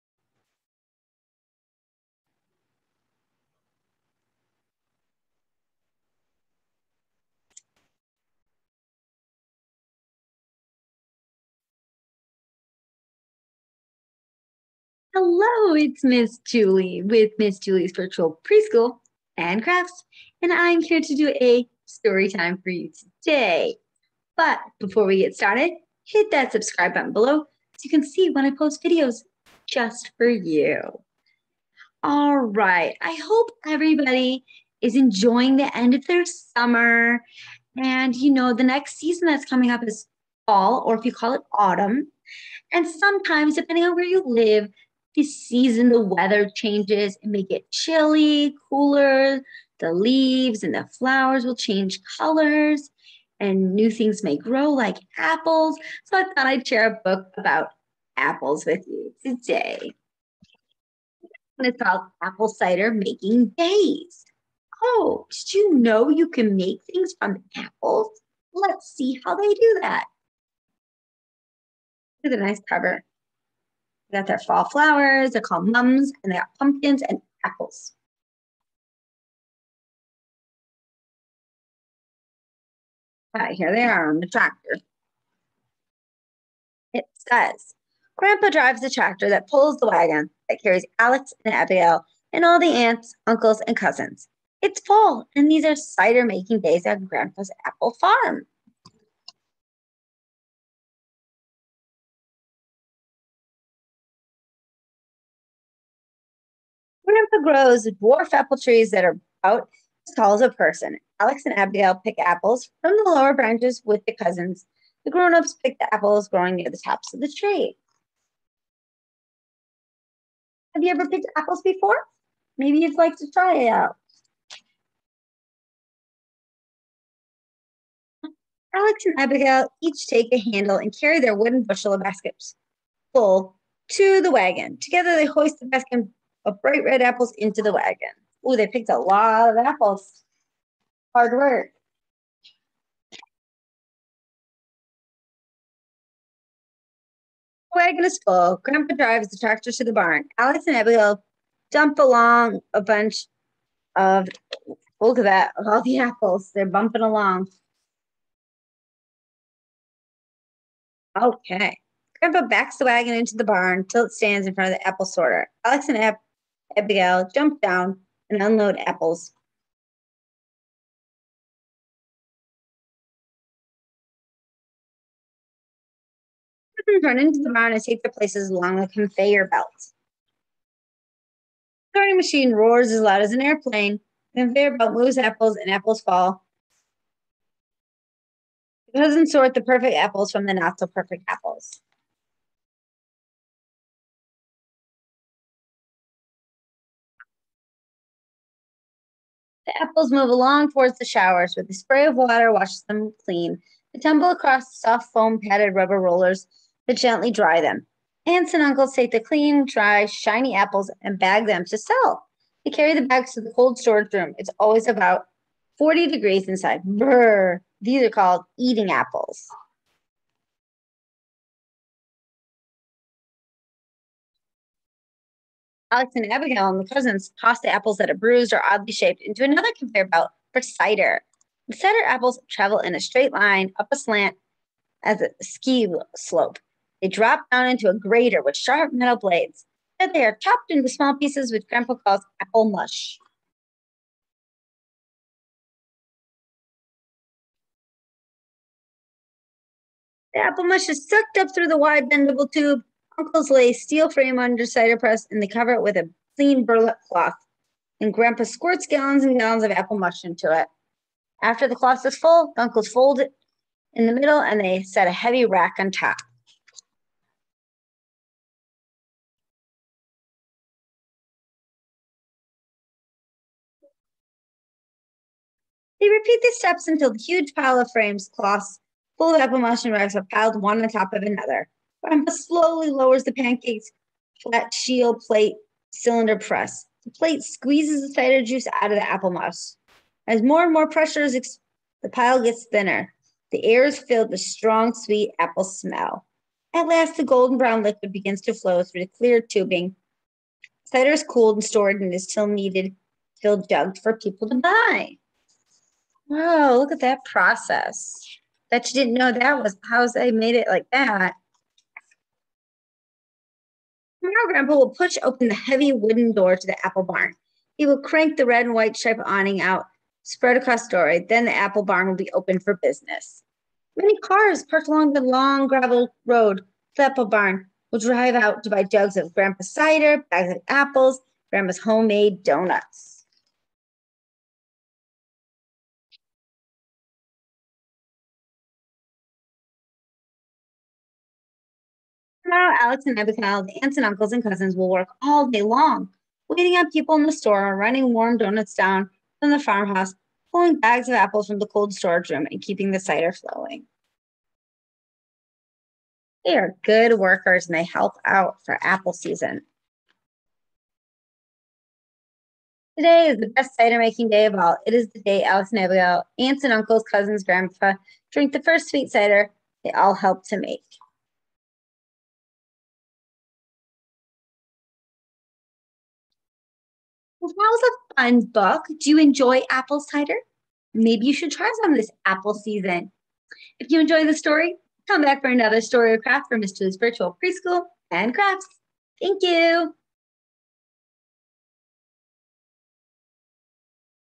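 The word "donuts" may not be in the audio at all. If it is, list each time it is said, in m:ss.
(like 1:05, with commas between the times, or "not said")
5:32, 5:48.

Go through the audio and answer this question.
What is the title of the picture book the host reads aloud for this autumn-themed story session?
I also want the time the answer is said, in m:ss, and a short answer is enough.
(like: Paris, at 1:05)
Apple Cider Making Days, at 1:02.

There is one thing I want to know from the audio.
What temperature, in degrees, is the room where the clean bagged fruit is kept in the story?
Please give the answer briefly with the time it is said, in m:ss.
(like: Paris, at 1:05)
40 degrees, at 3:35.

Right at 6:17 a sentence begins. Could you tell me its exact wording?
Well, that was a fun book.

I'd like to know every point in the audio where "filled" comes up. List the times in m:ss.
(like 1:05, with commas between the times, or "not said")
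4:53, 5:03.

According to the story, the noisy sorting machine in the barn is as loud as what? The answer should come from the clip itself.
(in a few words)
an airplane.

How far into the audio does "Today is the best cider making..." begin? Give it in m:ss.
6:02.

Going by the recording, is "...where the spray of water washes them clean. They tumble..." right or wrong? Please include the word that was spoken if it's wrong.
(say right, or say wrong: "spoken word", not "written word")
right.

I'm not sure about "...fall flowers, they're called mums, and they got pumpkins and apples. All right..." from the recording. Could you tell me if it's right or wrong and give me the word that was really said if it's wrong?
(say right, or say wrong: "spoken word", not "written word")
right.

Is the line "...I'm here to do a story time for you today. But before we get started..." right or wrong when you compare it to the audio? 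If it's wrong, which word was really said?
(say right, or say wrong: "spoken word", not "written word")
right.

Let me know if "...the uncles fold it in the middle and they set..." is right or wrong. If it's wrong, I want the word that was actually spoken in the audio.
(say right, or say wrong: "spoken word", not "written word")
right.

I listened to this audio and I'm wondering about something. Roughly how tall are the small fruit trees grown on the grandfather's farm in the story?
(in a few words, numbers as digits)
about as tall as a person.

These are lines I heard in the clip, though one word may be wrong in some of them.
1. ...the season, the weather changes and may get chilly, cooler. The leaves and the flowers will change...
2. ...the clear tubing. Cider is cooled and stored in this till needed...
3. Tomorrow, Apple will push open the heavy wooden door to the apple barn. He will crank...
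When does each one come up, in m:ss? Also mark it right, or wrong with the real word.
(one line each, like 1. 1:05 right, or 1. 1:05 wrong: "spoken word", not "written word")
1. 0:45 right
2. 4:59 right
3. 5:14 wrong: "Grandpa", not "Apple".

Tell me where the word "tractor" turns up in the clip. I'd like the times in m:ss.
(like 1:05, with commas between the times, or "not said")
1:24, 1:28, 2:29.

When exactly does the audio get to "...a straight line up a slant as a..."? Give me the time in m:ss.
3:52.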